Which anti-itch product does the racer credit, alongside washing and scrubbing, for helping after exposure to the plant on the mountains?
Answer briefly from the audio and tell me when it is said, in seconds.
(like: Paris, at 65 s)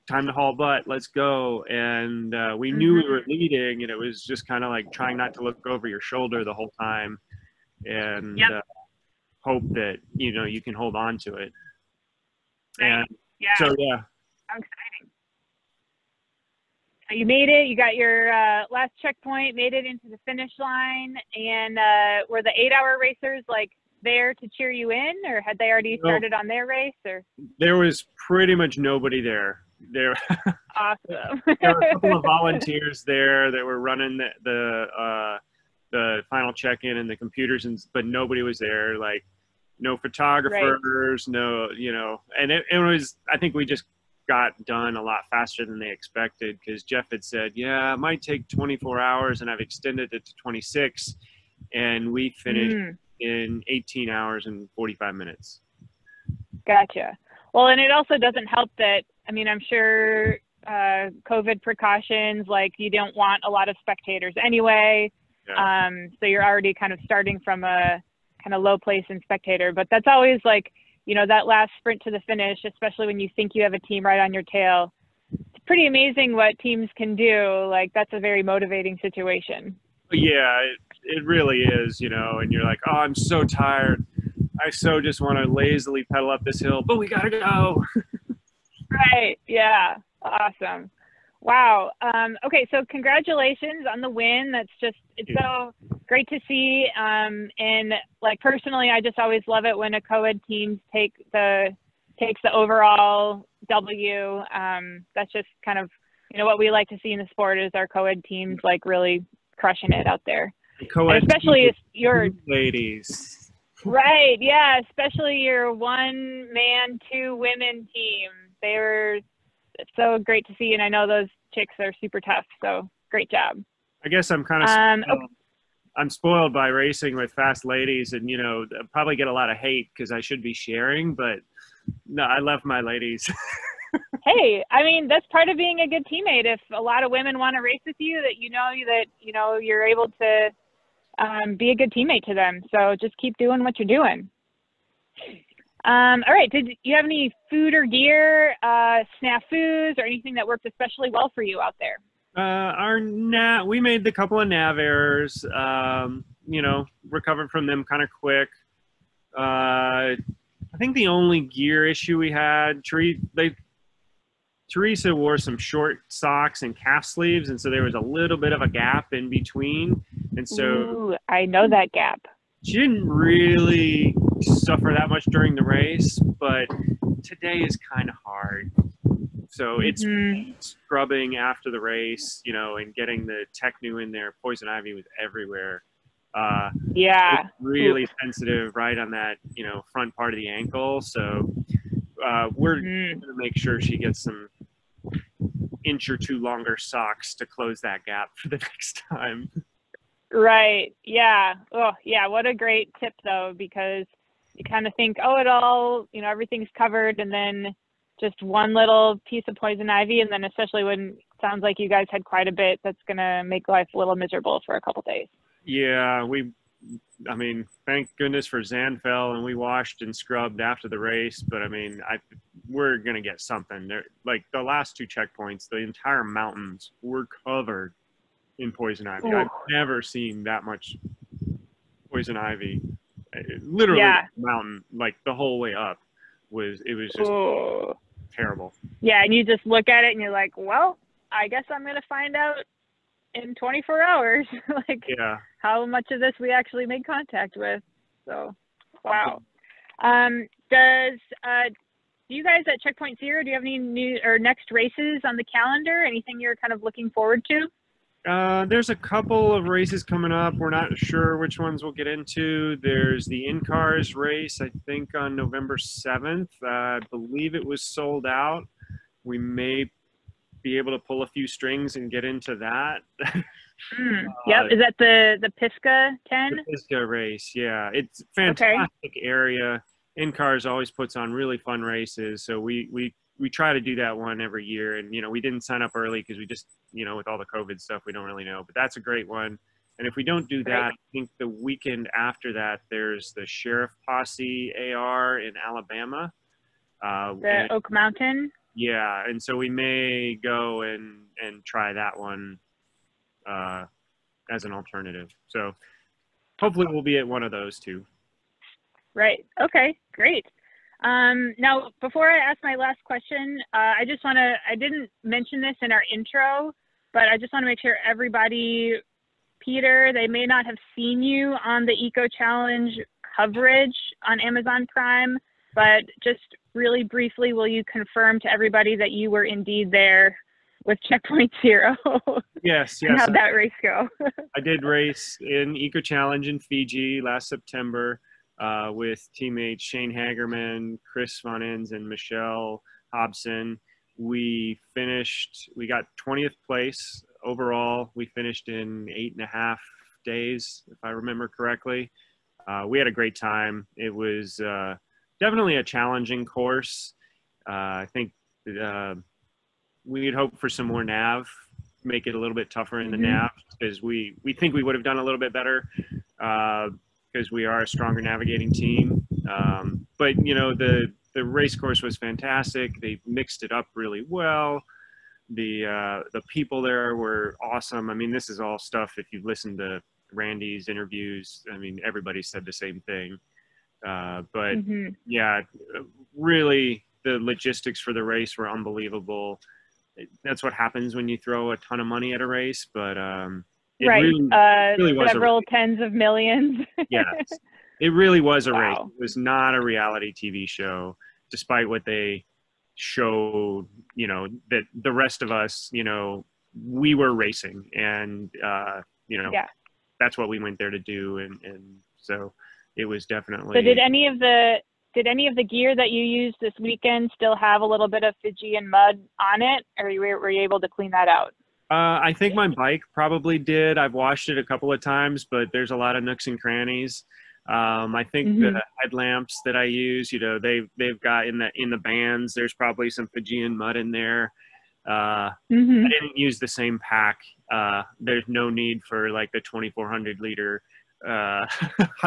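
Zanfel, at 218 s.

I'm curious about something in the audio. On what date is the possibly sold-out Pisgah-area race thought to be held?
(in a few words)
November 7.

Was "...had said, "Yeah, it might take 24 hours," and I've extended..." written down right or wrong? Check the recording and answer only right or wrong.
right.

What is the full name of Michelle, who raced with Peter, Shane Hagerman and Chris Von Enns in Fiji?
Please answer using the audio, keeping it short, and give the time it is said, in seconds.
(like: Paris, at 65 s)
Michelle Hobson, at 342 s.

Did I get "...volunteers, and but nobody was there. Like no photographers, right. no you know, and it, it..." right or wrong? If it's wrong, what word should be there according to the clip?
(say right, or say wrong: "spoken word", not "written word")
wrong: "computers", not "volunteers".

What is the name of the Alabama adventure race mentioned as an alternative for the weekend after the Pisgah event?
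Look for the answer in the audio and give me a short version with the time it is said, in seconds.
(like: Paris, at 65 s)
Sheriff Posse AR, at 293 s.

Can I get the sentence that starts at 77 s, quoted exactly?
Like, that's a very motivating situation.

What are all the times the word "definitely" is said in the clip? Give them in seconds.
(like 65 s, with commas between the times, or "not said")
355 s, 413 s.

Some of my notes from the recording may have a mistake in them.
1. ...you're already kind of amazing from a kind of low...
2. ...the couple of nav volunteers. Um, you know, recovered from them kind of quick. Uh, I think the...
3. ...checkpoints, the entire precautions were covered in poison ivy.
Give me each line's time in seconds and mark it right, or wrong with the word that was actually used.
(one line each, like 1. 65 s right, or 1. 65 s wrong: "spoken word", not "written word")
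1. 66 s wrong: "starting", not "amazing"
2. 154 s wrong: "errors", not "volunteers"
3. 225 s wrong: "mountains", not "precautions".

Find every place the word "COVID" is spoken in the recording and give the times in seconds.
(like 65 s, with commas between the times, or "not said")
61 s, 287 s.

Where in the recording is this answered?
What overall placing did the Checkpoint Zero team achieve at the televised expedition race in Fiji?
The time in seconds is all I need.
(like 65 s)
346 s.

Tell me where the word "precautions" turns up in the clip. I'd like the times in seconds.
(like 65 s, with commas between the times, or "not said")
61 s.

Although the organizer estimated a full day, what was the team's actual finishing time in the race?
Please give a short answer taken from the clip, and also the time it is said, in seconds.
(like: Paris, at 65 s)
18 hours and 45 minutes, at 53 s.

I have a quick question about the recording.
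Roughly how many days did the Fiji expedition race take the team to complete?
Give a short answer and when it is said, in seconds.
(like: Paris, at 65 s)
8.5 days, at 349 s.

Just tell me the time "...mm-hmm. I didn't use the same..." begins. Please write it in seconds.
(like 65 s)
435 s.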